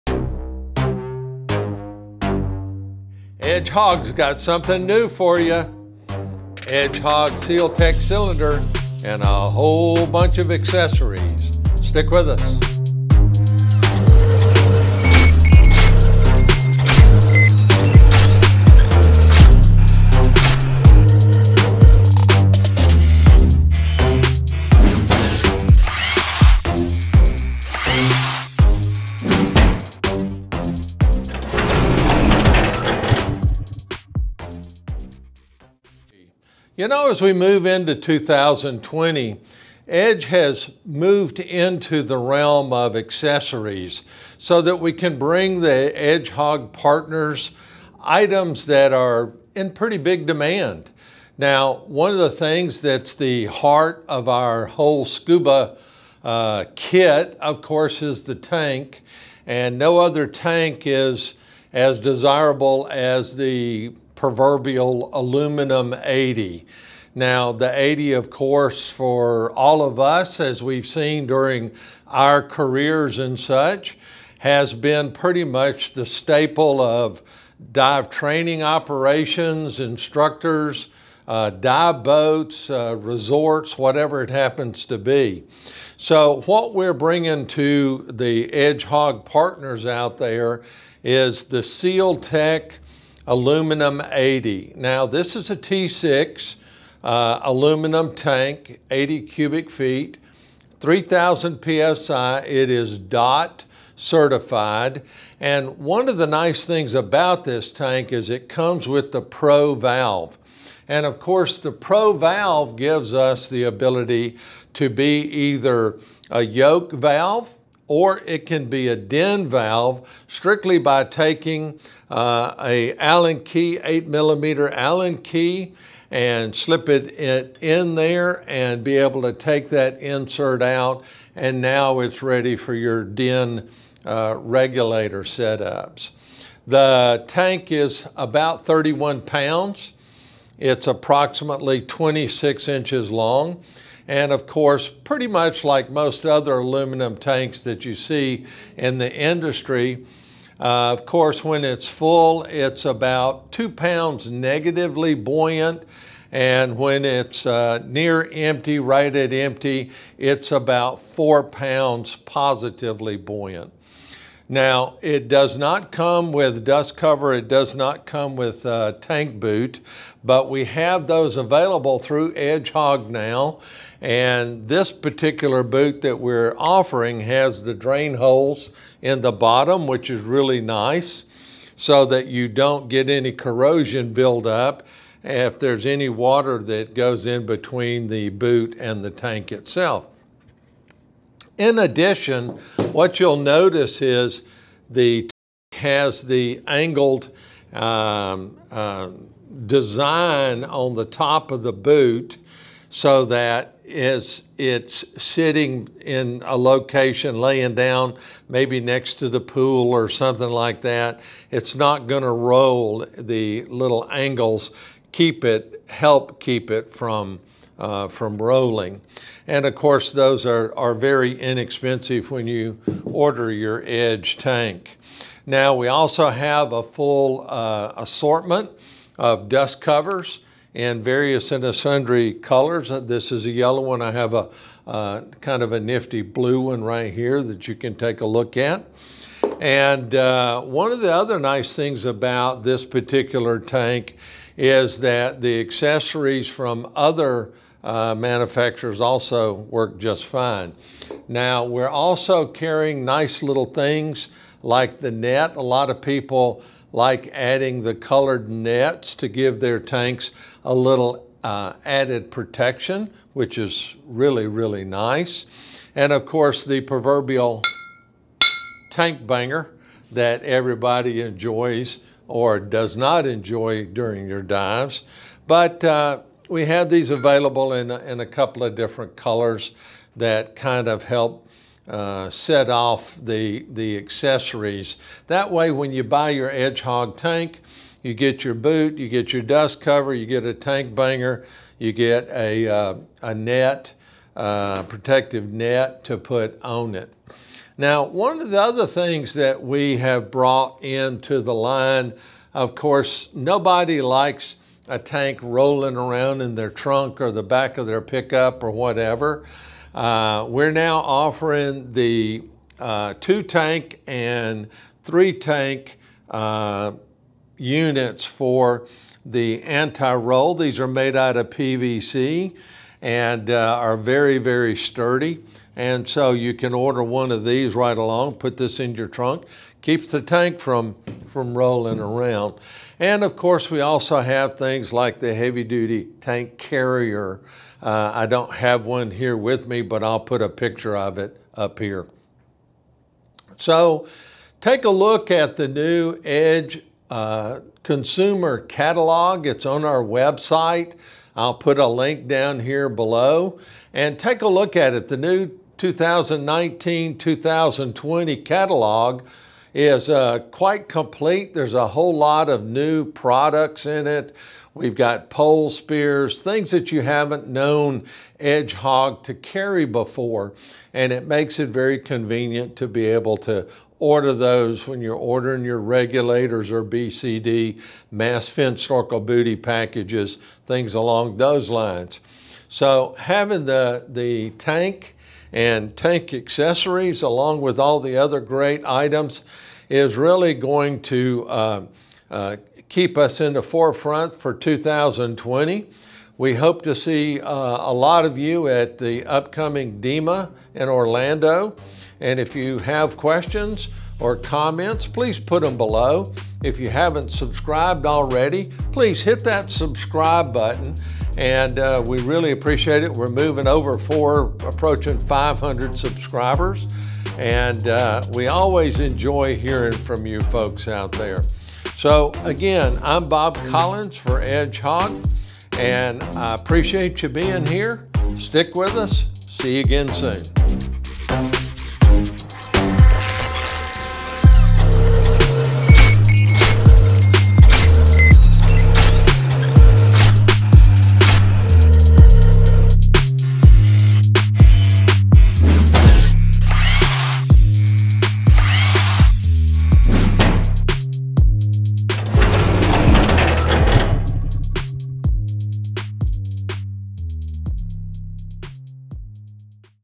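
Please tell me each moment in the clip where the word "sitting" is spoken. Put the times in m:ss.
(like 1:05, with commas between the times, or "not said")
3:25.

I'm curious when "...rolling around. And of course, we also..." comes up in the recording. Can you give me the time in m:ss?
5:31.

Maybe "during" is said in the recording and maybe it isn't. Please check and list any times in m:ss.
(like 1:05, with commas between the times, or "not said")
1:11, 4:33.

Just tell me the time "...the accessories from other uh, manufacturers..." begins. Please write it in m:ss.
4:05.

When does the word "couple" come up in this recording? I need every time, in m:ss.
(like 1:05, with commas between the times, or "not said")
4:38.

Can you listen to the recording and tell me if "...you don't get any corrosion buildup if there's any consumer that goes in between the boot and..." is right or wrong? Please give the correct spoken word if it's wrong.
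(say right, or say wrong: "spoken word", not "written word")
wrong: "water", not "consumer".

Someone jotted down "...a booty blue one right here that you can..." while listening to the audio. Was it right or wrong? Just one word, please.
wrong.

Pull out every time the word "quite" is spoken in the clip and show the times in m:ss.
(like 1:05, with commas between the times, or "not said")
6:00.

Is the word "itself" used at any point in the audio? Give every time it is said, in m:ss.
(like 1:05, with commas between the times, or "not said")
3:09.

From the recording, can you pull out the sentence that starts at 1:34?
Now this is a T6 uh, aluminum tank, 80 cubic feet, 3000 PSI.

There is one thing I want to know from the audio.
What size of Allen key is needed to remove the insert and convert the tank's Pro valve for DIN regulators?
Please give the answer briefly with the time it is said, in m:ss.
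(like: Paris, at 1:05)
8 millimeter, at 2:03.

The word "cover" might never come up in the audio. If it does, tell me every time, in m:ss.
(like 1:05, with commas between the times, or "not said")
2:46, 3:49, 4:49.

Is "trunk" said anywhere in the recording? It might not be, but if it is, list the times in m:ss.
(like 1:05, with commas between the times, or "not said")
5:06, 5:29.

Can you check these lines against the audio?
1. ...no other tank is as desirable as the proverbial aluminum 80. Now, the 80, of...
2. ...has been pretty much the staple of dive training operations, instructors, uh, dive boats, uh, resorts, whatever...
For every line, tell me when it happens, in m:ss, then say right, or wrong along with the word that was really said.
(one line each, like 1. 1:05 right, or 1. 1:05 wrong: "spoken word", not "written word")
1. 0:59 right
2. 1:14 right.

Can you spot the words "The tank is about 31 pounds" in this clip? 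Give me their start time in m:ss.
2:16.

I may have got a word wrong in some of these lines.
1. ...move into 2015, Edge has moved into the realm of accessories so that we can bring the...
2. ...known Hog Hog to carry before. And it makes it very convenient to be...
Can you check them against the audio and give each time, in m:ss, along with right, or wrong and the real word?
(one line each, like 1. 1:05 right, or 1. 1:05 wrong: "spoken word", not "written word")
1. 0:37 wrong: "2020", not "2015"
2. 6:07 wrong: "Edge", not "Hog".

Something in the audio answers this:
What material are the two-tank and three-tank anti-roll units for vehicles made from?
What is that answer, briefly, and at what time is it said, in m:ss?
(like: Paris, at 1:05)
PVC, at 5:21.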